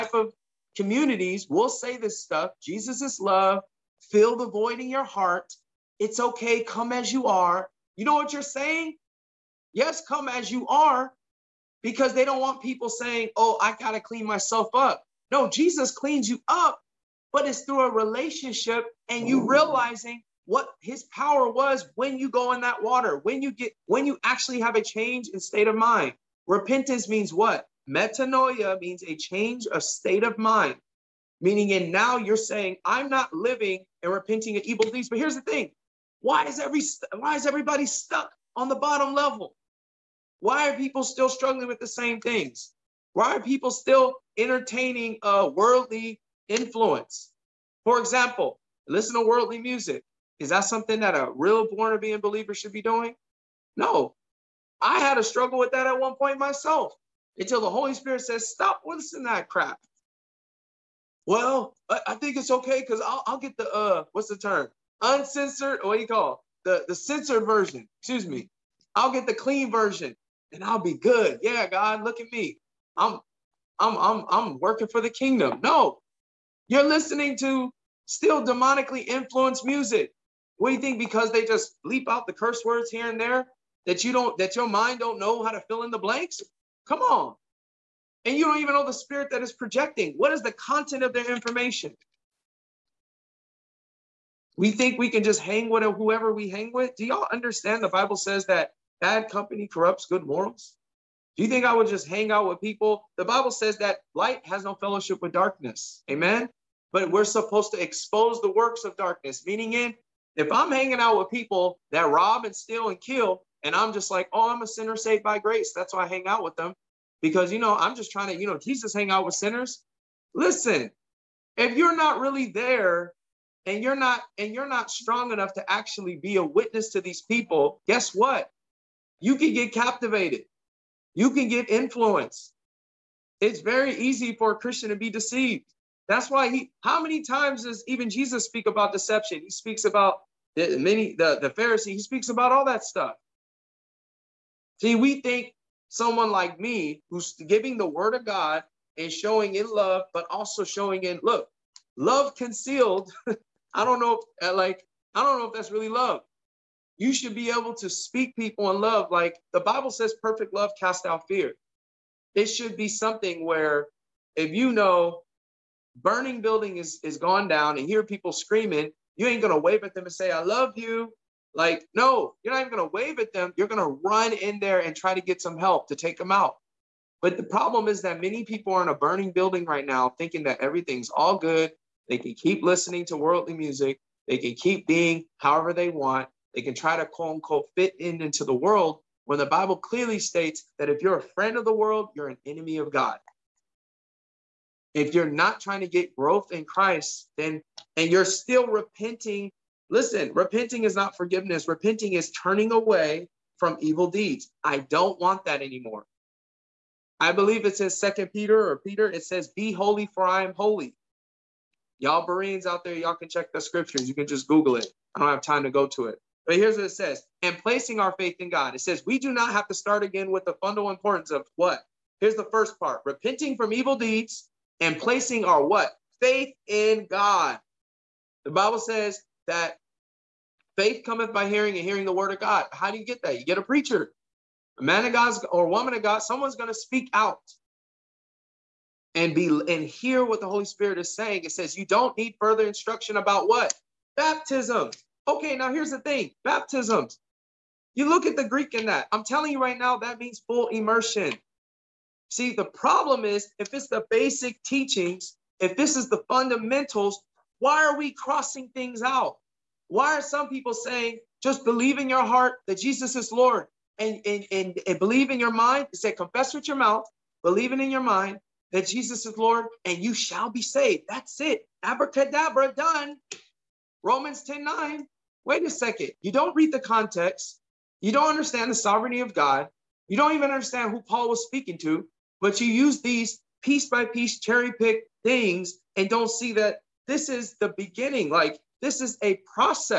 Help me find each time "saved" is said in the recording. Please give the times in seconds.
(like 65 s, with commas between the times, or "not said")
114 s, 270 s.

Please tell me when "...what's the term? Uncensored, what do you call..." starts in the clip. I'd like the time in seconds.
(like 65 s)
64 s.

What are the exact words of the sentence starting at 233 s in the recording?
You get a preacher, a man of God or woman of God.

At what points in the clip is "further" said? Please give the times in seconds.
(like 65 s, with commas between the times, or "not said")
242 s.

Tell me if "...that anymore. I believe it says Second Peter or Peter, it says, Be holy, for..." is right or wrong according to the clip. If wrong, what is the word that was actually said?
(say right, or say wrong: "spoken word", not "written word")
right.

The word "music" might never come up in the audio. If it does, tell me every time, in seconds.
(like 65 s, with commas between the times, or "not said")
49 s, 79 s, 183 s.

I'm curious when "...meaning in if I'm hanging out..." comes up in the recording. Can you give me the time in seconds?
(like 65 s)
109 s.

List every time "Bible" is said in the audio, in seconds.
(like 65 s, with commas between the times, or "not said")
97 s, 103 s, 159 s, 189 s, 228 s.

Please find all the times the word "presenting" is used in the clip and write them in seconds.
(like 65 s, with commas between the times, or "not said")
not said.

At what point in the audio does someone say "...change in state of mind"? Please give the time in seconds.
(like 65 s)
24 s.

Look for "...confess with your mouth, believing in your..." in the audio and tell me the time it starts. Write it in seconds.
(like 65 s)
266 s.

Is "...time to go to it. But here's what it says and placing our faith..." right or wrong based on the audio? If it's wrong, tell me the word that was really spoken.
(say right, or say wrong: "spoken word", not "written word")
right.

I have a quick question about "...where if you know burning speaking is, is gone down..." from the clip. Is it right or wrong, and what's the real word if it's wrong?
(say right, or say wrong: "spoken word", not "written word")
wrong: "building", not "speaking".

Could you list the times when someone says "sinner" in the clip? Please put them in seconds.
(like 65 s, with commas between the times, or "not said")
114 s, 119 s.